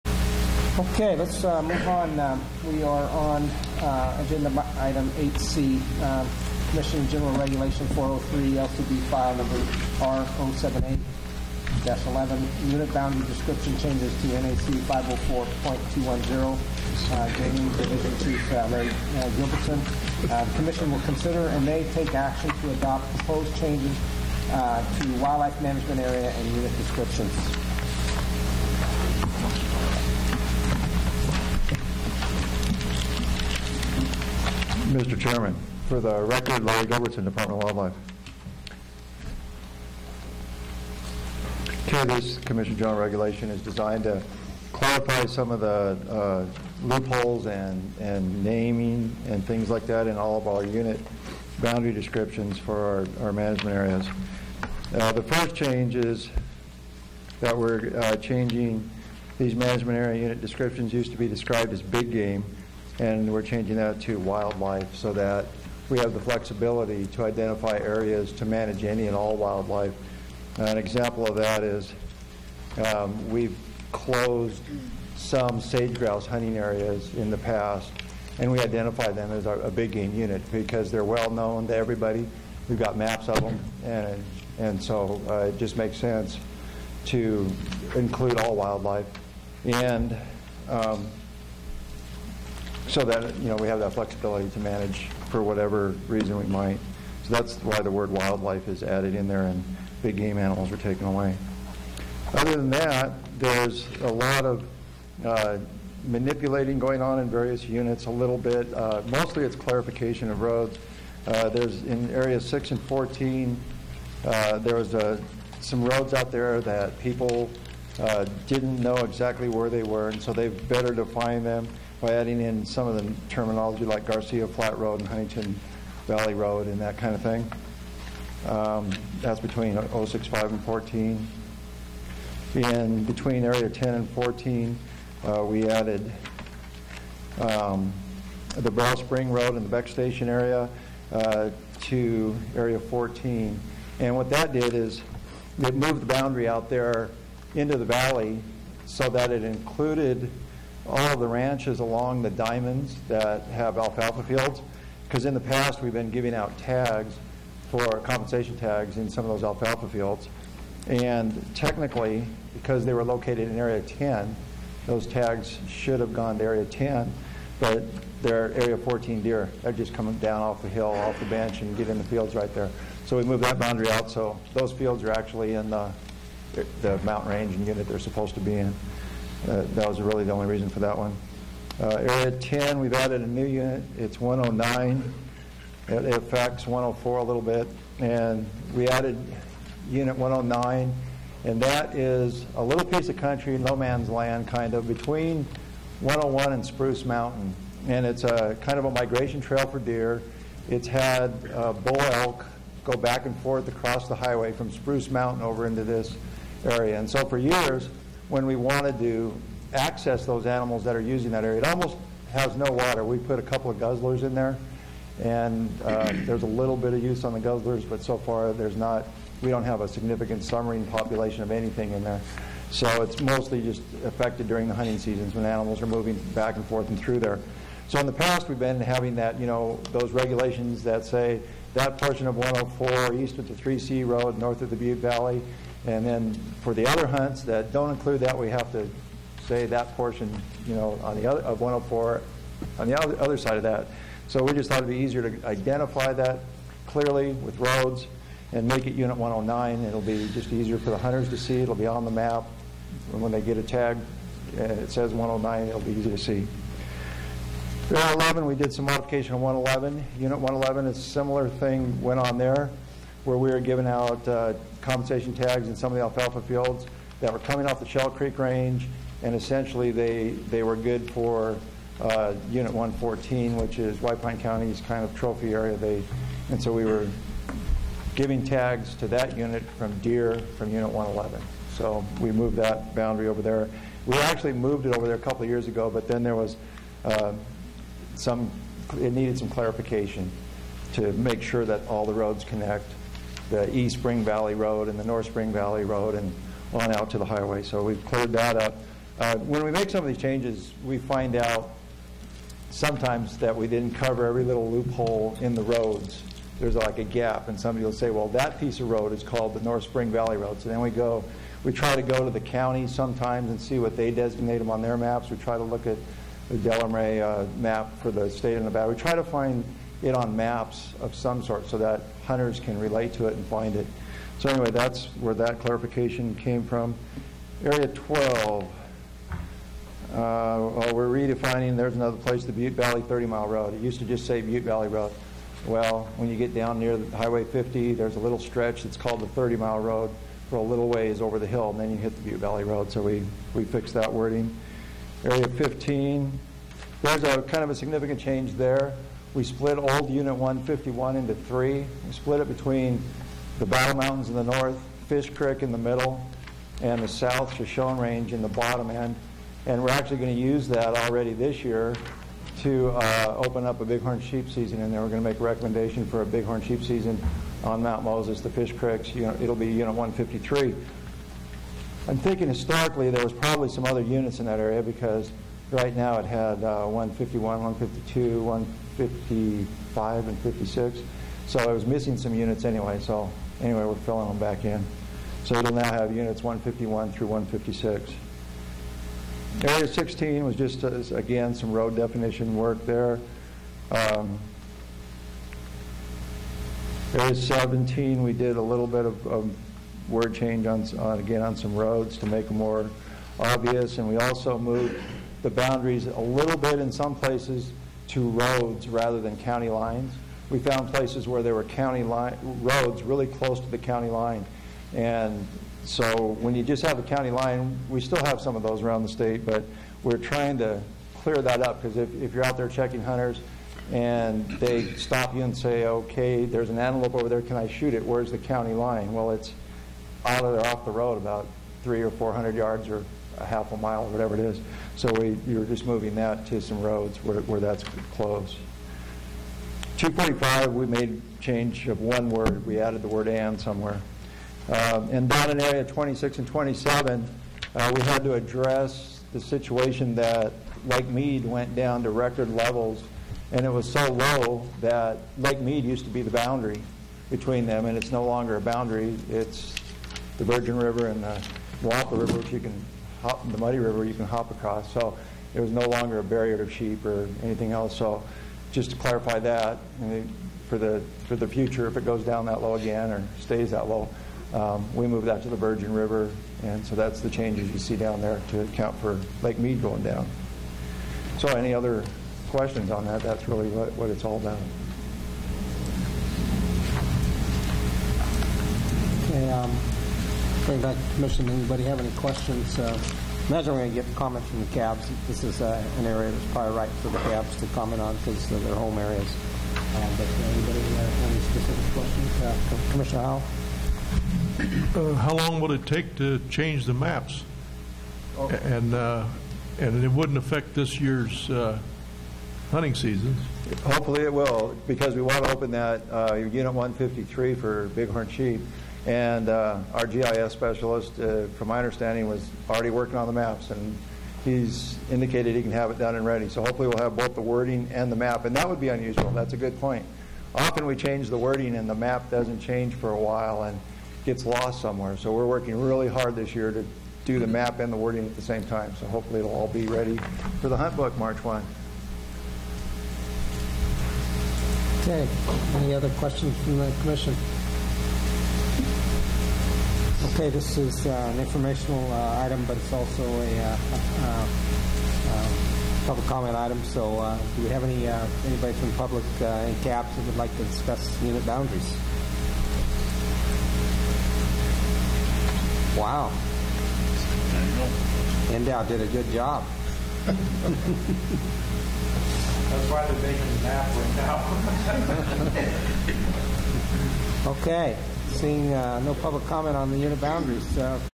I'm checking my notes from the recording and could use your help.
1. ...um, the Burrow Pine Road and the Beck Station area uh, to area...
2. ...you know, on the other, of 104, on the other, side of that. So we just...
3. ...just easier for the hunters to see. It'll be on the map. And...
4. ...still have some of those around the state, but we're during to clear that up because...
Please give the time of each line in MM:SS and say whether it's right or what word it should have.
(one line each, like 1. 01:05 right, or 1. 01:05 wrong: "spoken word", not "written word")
1. 02:17 wrong: "Spring", not "Pine"
2. 04:00 right
3. 04:10 right
4. 06:58 wrong: "trying", not "during".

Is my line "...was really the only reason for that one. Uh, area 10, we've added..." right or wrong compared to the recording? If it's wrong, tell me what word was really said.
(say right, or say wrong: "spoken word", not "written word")
right.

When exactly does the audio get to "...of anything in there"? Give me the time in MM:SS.
03:41.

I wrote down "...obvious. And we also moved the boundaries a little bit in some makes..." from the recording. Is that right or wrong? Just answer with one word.
wrong.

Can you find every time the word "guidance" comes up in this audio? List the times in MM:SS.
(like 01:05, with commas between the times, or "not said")
not said.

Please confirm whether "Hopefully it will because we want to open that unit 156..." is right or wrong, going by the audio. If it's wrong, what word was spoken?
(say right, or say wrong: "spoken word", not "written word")
wrong: "153", not "156".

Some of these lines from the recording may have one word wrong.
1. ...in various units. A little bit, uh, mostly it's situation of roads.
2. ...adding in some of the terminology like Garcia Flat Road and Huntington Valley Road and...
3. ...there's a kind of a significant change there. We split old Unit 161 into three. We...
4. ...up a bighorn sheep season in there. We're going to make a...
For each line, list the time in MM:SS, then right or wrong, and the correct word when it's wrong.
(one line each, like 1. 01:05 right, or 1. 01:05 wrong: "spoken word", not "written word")
1. 01:47 wrong: "clarification", not "situation"
2. 02:02 right
3. 05:47 wrong: "151", not "161"
4. 06:03 right.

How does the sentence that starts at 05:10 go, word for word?
So then we go, we try to go to the county sometimes and see what they designate them on their maps.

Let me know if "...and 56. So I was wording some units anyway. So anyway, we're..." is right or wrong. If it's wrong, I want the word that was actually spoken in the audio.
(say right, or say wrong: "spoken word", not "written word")
wrong: "missing", not "wording".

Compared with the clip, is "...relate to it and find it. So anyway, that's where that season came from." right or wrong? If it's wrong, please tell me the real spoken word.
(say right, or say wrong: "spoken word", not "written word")
wrong: "clarification", not "season".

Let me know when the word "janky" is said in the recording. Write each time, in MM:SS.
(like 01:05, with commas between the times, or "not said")
not said.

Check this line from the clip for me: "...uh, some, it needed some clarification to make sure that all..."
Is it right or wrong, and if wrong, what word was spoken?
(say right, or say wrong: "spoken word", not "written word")
right.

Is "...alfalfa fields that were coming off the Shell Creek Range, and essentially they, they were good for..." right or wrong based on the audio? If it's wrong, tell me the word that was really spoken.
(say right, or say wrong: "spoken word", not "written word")
right.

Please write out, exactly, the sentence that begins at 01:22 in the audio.
We've got maps of them, and, and so uh, it just makes sense to include all wildlife.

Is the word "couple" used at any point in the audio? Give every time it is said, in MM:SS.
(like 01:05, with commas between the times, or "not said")
03:33, 04:45.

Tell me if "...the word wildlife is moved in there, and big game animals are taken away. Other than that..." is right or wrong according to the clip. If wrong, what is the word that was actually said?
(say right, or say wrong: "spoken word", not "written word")
wrong: "added", not "moved".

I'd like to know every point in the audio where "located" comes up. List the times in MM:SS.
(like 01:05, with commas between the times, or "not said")
02:43.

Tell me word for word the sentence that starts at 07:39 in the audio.
It's the Virgin River and the Moapa River, which you can hop the muddy river you can hop across.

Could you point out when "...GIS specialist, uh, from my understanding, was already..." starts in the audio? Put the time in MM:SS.
08:40.